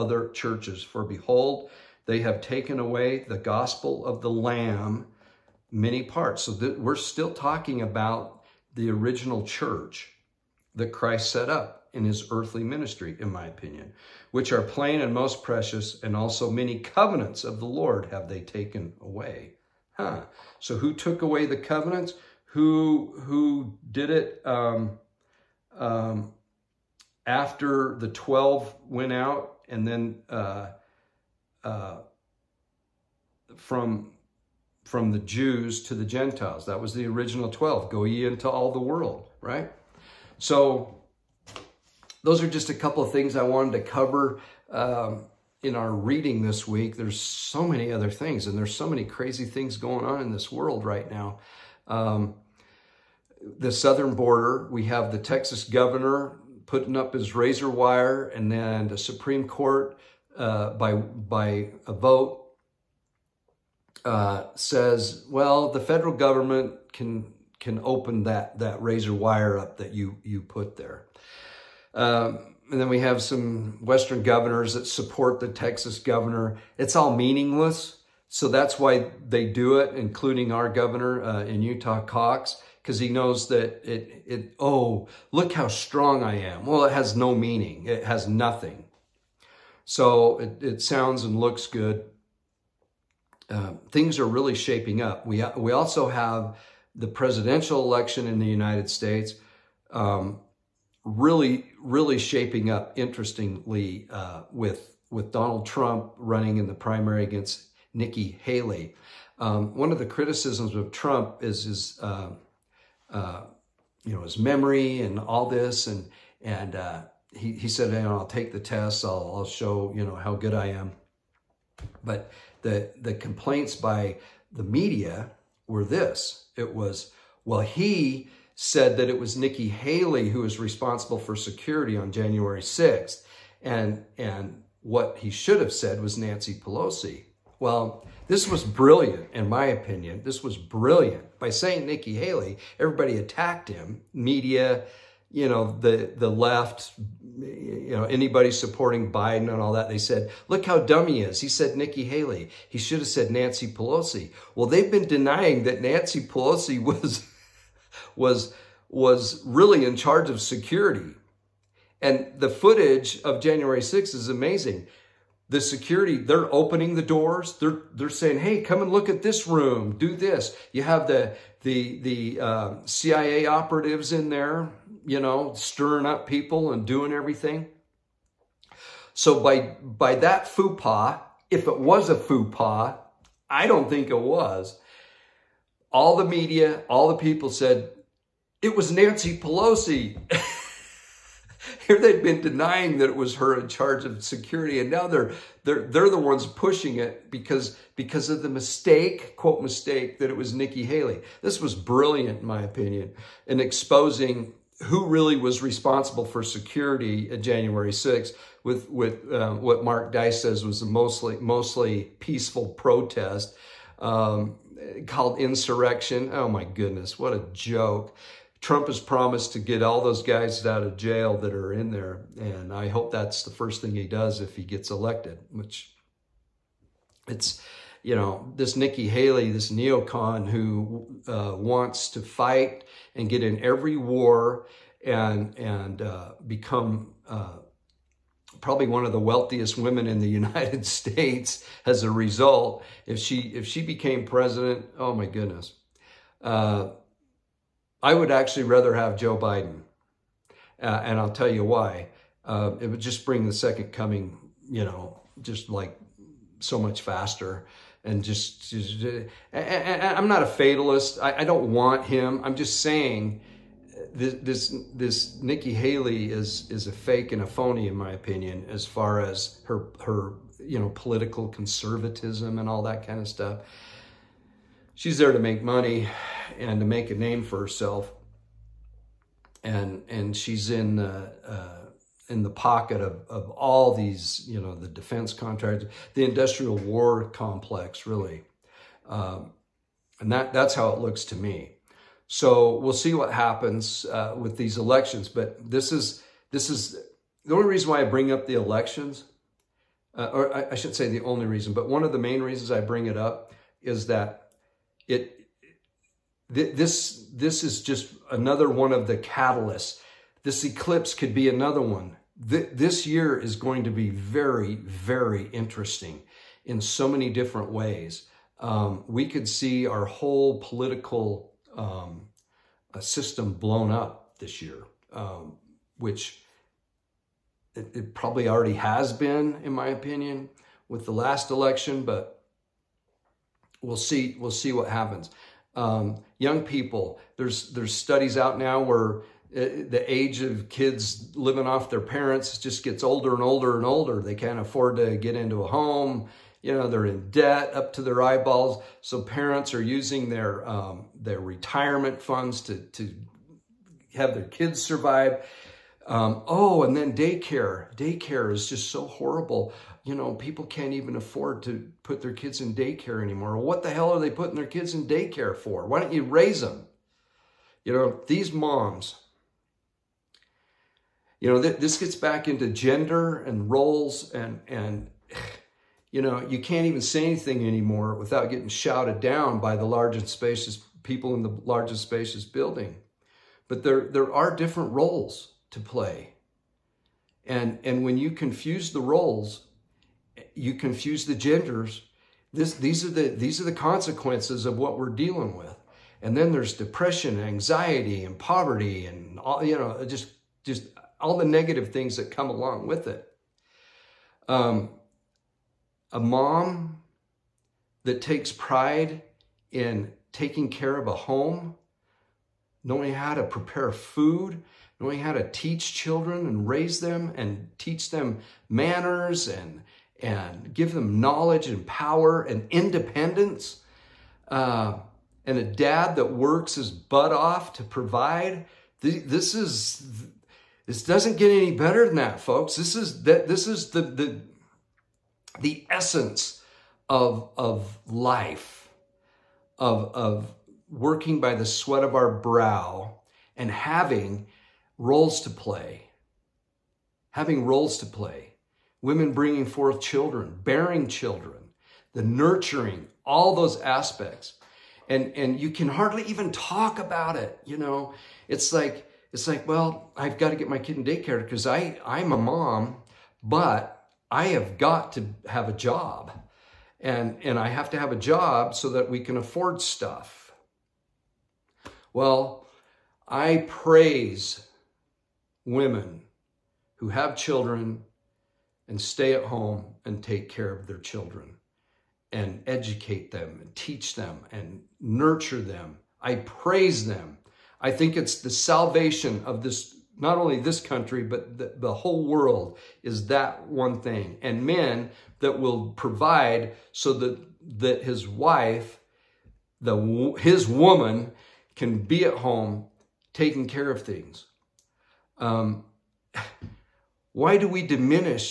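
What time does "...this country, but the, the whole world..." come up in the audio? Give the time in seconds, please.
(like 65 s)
490 s.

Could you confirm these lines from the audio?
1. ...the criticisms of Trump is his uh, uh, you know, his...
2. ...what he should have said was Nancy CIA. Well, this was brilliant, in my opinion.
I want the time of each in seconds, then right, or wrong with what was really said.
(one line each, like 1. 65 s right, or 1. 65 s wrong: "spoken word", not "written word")
1. 109 s right
2. 134 s wrong: "Pelosi", not "CIA".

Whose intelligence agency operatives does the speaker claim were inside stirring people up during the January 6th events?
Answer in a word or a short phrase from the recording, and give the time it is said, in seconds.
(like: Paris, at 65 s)
CIA, at 172 s.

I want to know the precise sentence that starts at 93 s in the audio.
Uh, things are really shaping up.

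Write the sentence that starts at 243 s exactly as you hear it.
If she, if she became president, oh my goodness.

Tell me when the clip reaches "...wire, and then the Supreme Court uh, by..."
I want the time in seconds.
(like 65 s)
57 s.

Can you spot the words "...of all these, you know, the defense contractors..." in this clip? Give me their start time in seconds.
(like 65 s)
283 s.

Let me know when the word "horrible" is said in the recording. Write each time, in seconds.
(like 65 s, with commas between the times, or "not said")
359 s.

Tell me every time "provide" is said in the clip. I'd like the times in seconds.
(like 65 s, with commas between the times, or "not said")
427 s, 495 s.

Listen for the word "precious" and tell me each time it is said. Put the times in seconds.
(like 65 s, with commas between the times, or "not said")
15 s.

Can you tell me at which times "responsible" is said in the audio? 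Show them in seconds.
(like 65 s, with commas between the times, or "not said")
130 s, 205 s.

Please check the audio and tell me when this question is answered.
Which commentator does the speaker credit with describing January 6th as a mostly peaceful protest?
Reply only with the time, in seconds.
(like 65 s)
209 s.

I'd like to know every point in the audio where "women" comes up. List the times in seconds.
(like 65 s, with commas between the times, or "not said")
239 s, 449 s, 475 s.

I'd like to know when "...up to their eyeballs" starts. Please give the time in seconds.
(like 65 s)
347 s.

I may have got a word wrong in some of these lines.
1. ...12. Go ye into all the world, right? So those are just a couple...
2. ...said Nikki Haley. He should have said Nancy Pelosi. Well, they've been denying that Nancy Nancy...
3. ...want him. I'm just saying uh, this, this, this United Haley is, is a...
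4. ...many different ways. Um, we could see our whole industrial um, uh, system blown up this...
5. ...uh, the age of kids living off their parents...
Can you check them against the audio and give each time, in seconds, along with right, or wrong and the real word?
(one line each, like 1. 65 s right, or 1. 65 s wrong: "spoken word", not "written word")
1. 37 s right
2. 151 s wrong: "Pelosi", not "Nancy"
3. 261 s wrong: "Nikki", not "United"
4. 317 s wrong: "political", not "industrial"
5. 339 s right.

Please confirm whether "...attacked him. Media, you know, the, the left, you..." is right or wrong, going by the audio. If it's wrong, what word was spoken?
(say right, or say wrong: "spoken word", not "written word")
right.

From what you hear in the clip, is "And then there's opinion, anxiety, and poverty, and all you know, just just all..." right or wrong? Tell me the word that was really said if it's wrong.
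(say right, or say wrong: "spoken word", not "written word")
wrong: "depression", not "opinion".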